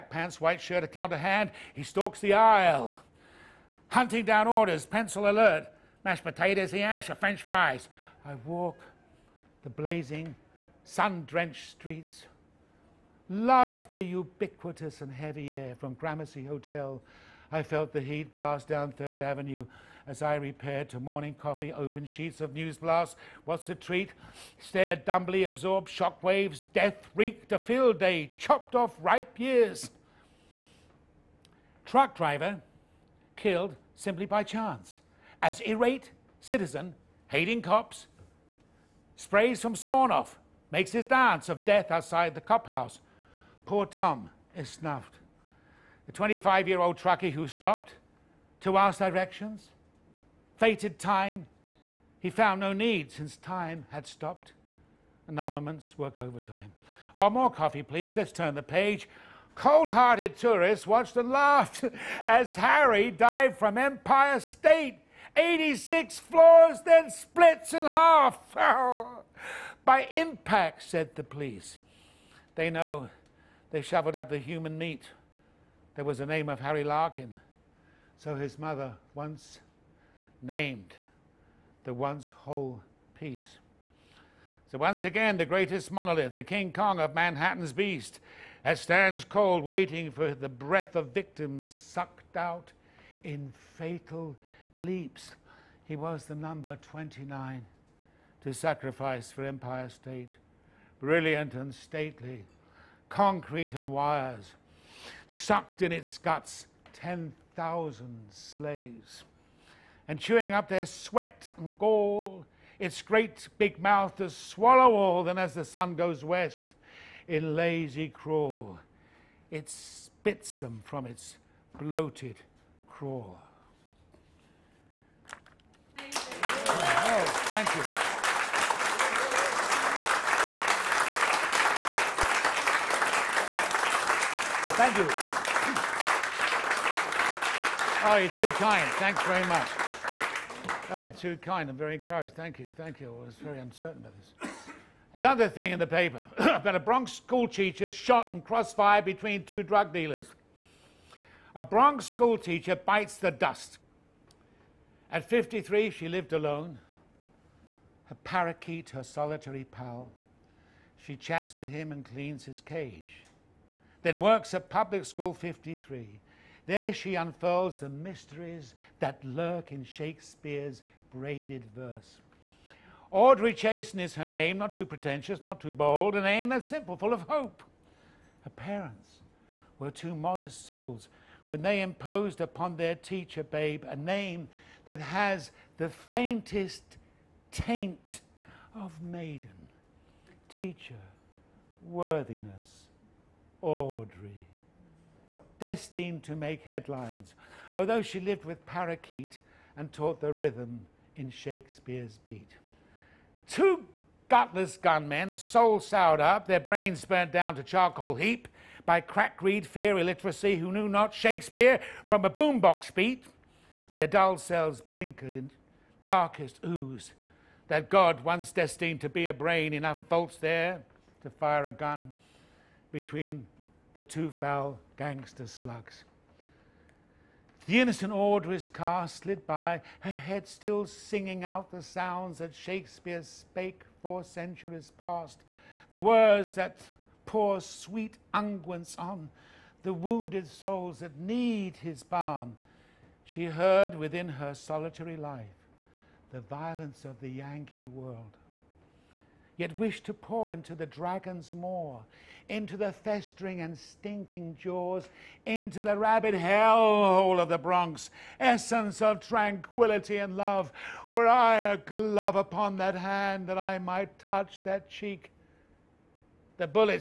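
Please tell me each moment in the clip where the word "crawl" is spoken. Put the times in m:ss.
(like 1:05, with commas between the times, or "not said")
1:58, 2:02.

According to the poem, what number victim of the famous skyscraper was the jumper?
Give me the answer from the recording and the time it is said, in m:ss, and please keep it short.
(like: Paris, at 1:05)
29, at 1:36.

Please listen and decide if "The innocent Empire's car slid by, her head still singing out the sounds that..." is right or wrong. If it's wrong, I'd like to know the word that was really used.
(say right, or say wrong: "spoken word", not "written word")
wrong: "Audrey", not "Empire".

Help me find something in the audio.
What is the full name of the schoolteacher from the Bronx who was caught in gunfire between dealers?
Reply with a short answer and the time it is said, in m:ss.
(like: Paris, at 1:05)
Audrey Chasen, at 2:53.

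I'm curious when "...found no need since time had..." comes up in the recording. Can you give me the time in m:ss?
0:52.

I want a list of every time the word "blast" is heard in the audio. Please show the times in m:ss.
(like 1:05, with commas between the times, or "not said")
0:18.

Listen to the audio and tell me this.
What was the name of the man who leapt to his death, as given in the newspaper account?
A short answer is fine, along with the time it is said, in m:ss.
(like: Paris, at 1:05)
Harry Larkin, at 1:16.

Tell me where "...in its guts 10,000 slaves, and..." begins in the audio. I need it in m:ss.
1:45.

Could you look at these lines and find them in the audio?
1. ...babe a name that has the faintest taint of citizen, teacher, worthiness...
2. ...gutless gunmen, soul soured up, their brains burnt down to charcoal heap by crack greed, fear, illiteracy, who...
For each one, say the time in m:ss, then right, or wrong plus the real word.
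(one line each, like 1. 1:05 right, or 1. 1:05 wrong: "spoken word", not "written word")
1. 3:03 wrong: "maiden", not "citizen"
2. 3:24 right.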